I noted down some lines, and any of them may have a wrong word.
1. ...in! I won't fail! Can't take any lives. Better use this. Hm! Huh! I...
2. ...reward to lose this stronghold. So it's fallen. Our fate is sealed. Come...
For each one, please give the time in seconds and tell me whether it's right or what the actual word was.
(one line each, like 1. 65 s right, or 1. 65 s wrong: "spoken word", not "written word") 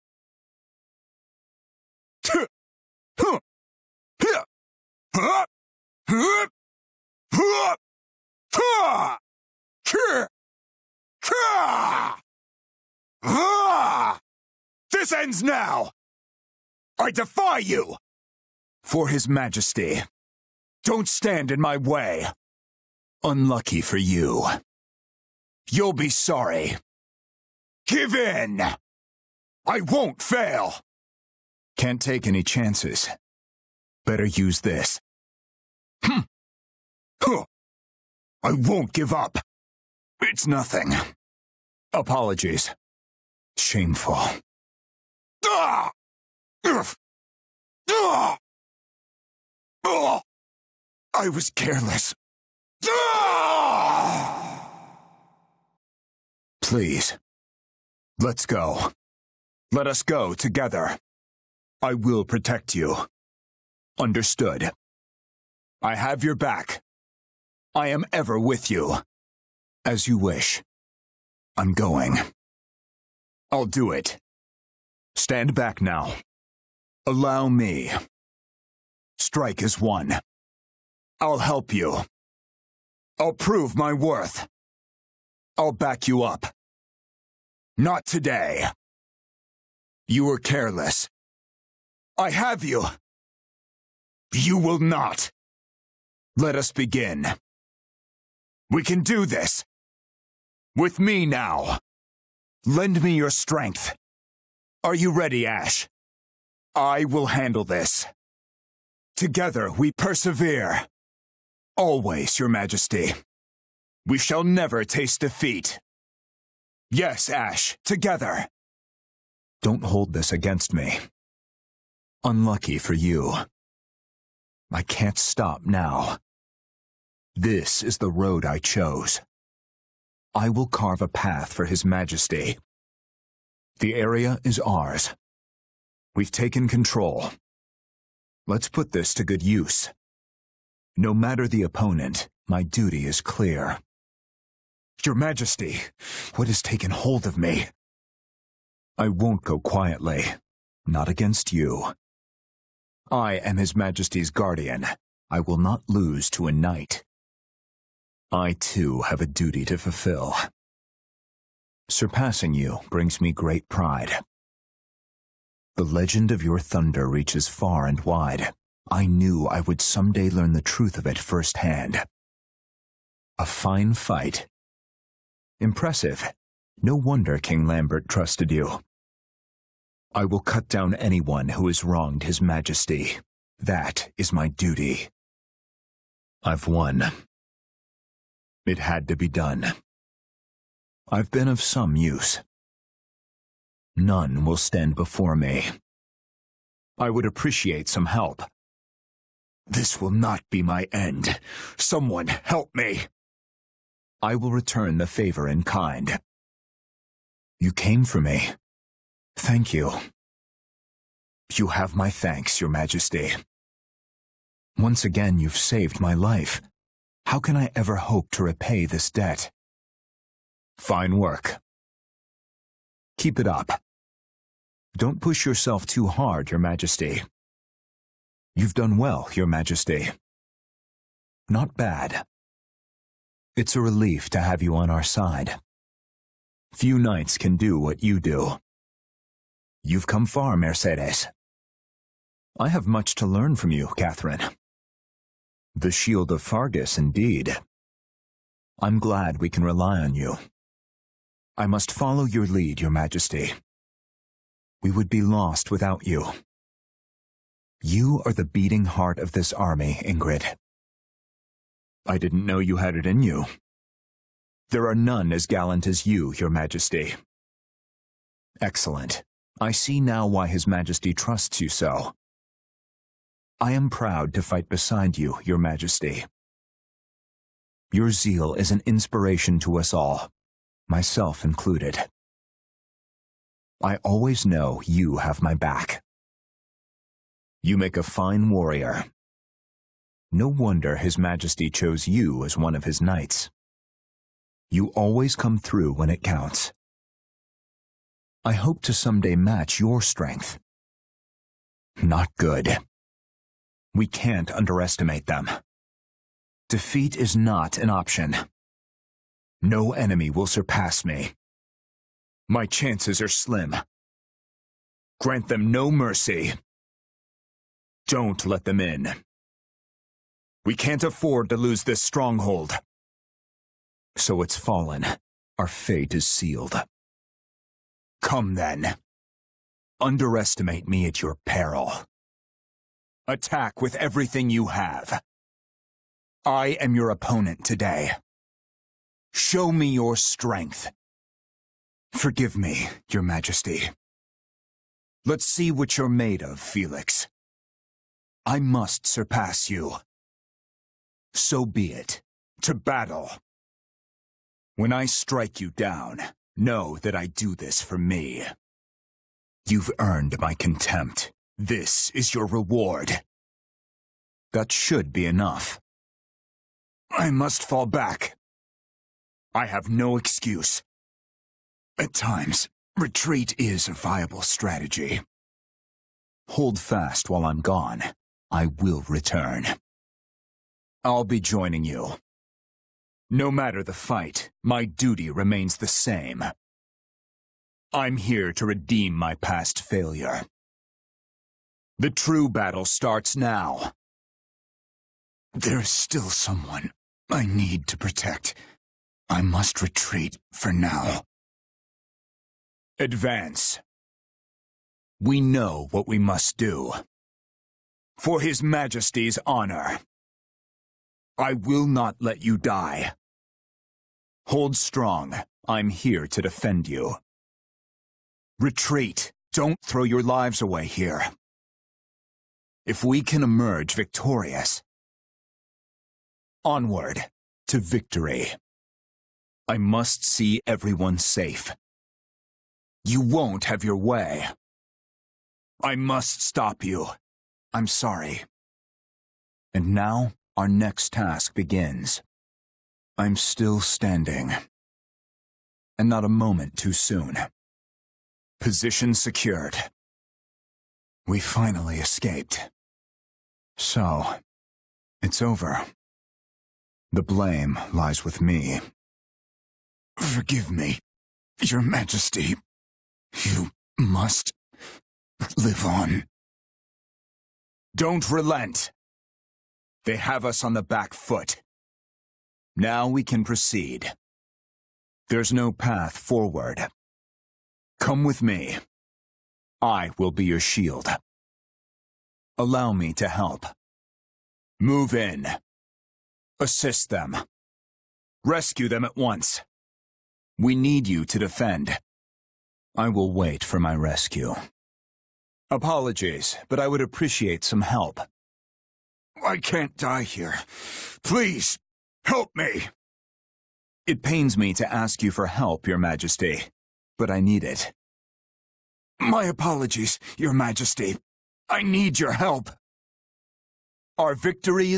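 1. 28 s wrong: "chances", not "lives"
2. 321 s wrong: "afford", not "reward".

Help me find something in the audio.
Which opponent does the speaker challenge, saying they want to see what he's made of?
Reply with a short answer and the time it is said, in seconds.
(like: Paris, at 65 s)
Felix, at 345 s.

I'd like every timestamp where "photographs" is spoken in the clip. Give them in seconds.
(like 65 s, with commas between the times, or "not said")
not said.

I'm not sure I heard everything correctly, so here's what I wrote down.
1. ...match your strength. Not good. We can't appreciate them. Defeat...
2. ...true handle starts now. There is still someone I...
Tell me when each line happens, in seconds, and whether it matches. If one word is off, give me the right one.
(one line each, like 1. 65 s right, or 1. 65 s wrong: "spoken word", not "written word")
1. 299 s wrong: "underestimate", not "appreciate"
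2. 392 s wrong: "battle", not "handle".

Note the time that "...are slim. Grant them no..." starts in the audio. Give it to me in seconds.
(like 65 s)
313 s.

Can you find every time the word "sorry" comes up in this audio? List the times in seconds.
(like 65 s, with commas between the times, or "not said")
26 s, 437 s.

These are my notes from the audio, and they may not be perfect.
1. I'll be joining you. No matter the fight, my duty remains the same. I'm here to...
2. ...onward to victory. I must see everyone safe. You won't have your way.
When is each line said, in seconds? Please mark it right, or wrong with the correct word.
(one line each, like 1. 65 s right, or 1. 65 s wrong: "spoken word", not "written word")
1. 381 s right
2. 426 s right.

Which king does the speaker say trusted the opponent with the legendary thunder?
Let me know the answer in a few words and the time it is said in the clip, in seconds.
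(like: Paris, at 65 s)
King Lambert, at 177 s.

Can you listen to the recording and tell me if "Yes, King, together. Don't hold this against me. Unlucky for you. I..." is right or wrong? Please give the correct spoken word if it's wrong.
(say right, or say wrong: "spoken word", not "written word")
wrong: "Ashe", not "King".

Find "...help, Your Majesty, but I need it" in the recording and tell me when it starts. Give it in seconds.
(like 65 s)
505 s.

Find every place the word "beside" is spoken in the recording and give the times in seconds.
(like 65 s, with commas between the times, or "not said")
274 s.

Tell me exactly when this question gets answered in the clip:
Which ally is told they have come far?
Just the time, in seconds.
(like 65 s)
239 s.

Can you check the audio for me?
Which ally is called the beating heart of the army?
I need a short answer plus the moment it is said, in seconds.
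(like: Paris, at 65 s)
Ingrid, at 257 s.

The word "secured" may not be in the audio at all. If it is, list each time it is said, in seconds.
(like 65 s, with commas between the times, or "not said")
449 s.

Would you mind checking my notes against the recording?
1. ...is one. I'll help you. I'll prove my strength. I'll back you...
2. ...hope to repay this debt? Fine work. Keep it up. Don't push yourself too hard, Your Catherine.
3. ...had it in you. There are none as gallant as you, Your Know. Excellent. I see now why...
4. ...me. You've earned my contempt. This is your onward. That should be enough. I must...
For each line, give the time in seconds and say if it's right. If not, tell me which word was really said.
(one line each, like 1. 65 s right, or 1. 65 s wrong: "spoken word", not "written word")
1. 79 s wrong: "worth", not "strength"
2. 217 s wrong: "Majesty", not "Catherine"
3. 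262 s wrong: "Majesty", not "Know"
4. 357 s wrong: "reward", not "onward".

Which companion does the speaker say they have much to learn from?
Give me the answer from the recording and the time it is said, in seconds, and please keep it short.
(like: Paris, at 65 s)
Catherine, at 242 s.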